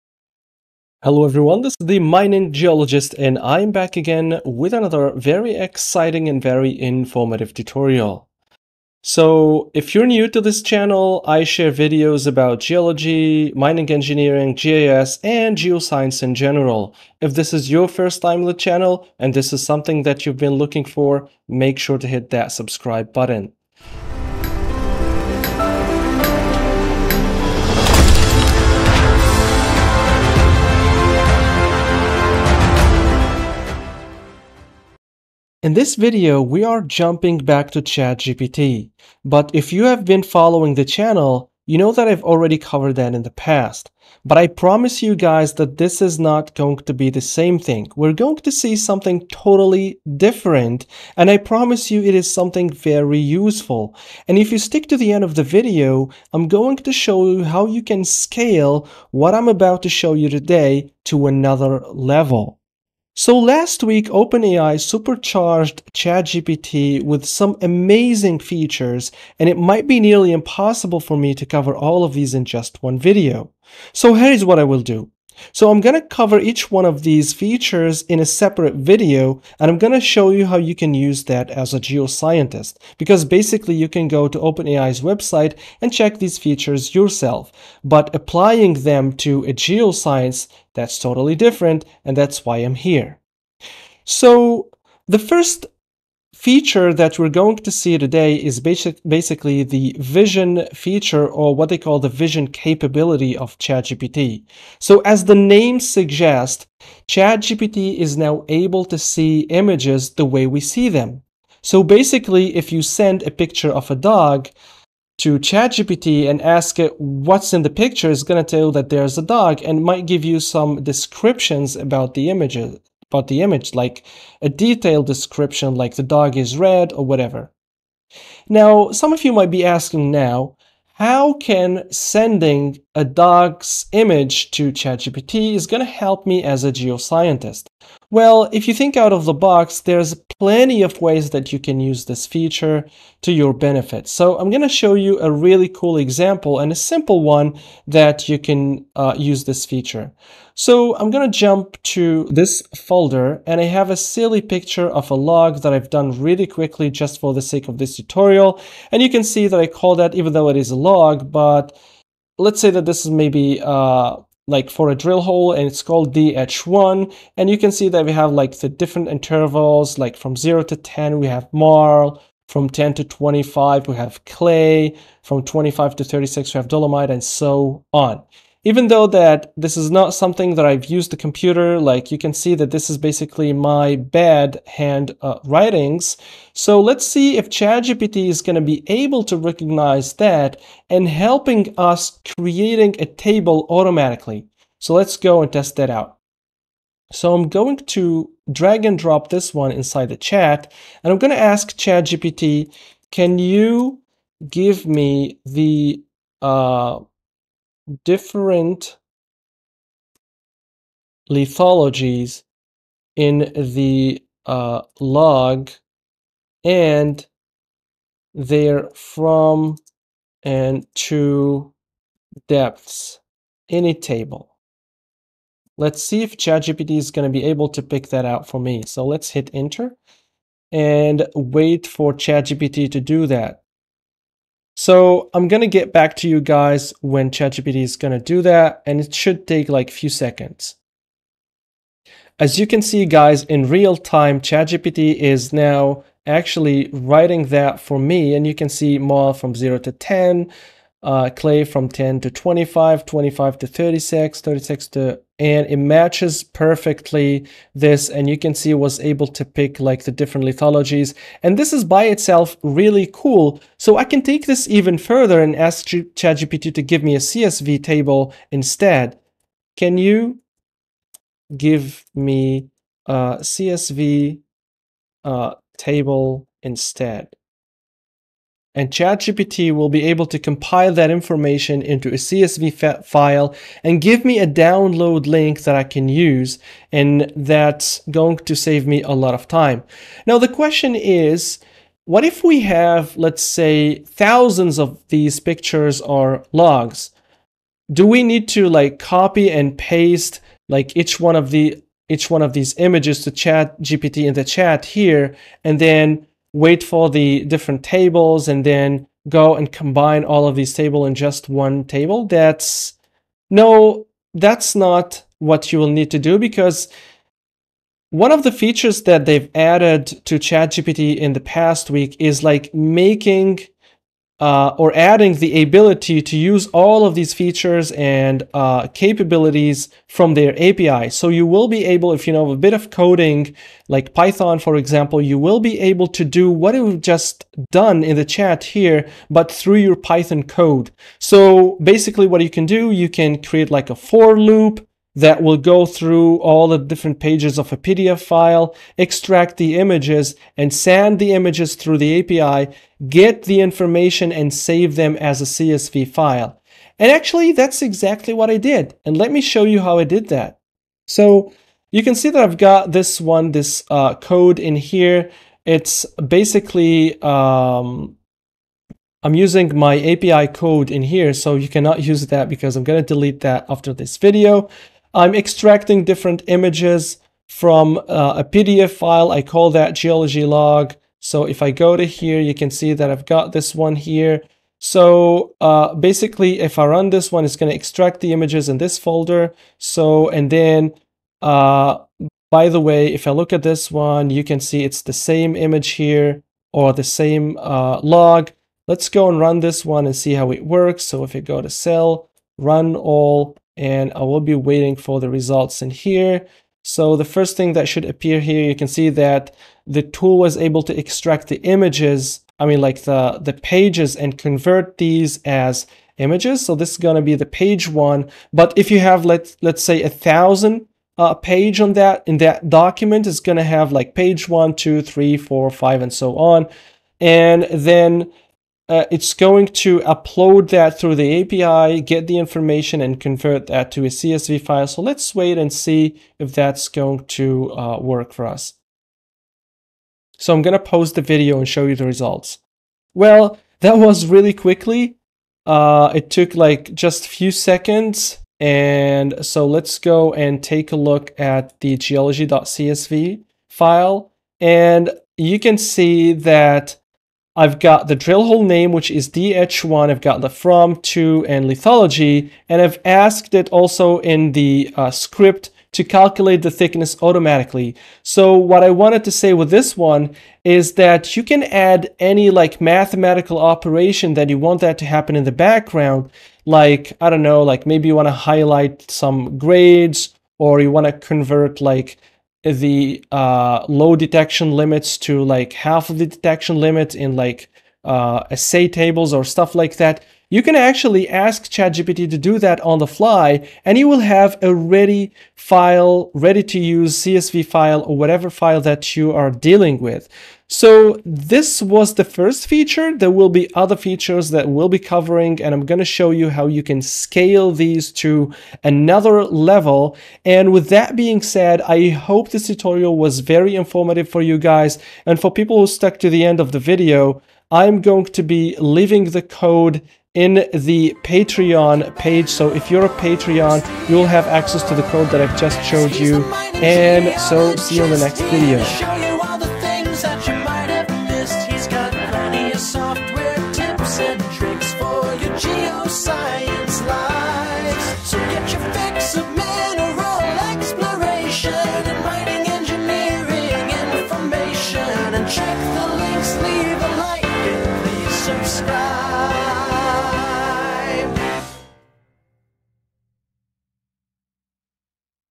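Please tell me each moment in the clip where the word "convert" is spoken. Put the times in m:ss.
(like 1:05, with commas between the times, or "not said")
6:54, 7:13, 8:01.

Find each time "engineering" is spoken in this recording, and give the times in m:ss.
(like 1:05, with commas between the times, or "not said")
0:13.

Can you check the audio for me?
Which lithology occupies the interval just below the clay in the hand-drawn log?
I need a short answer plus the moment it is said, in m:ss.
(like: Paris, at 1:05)
dolomite, at 2:56.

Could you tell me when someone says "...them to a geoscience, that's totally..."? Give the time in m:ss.
1:28.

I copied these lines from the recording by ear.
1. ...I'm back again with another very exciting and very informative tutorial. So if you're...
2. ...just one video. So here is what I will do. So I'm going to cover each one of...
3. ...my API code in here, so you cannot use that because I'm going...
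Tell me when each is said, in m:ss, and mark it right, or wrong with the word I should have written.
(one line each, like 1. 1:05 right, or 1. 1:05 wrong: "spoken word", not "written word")
1. 0:03 right
2. 1:12 right
3. 6:09 right.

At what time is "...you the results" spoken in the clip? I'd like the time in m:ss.
7:21.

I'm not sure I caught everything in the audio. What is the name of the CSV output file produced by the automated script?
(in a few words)
geology.csv.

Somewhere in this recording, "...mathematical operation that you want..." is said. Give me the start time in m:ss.
7:52.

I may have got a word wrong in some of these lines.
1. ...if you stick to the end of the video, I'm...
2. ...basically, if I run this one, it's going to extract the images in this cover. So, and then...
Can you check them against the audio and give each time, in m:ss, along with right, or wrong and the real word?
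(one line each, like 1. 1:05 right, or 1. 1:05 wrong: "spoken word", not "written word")
1. 0:54 right
2. 6:25 wrong: "folder", not "cover".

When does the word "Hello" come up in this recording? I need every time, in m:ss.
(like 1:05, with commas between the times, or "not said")
0:01.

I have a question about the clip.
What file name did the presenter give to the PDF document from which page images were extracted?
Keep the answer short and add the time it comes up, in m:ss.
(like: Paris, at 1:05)
geology log, at 6:19.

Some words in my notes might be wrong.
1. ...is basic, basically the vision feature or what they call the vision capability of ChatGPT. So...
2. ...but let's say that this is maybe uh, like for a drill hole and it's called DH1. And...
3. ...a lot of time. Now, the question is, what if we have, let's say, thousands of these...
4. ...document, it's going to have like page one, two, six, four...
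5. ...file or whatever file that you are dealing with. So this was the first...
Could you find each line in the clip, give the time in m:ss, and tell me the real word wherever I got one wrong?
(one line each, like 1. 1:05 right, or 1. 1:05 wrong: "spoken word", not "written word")
1. 1:38 right
2. 2:41 right
3. 4:49 right
4. 7:02 wrong: "three", not "six"
5. 8:17 right.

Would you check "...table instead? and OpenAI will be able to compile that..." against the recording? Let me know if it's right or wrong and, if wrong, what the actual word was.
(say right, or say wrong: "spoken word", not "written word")
wrong: "ChatGPT", not "OpenAI".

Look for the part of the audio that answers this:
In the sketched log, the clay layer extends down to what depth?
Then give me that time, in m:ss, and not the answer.
2:52.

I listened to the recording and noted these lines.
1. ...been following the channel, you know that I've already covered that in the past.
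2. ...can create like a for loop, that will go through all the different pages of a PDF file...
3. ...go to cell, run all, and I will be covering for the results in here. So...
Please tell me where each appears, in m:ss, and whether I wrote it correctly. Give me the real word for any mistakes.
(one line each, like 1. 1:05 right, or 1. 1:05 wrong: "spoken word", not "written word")
1. 0:40 right
2. 5:43 right
3. 6:41 wrong: "waiting", not "covering".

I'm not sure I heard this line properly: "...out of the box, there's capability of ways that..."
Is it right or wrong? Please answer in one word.
wrong.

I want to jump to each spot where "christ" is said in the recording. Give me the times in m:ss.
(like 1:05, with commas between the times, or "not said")
not said.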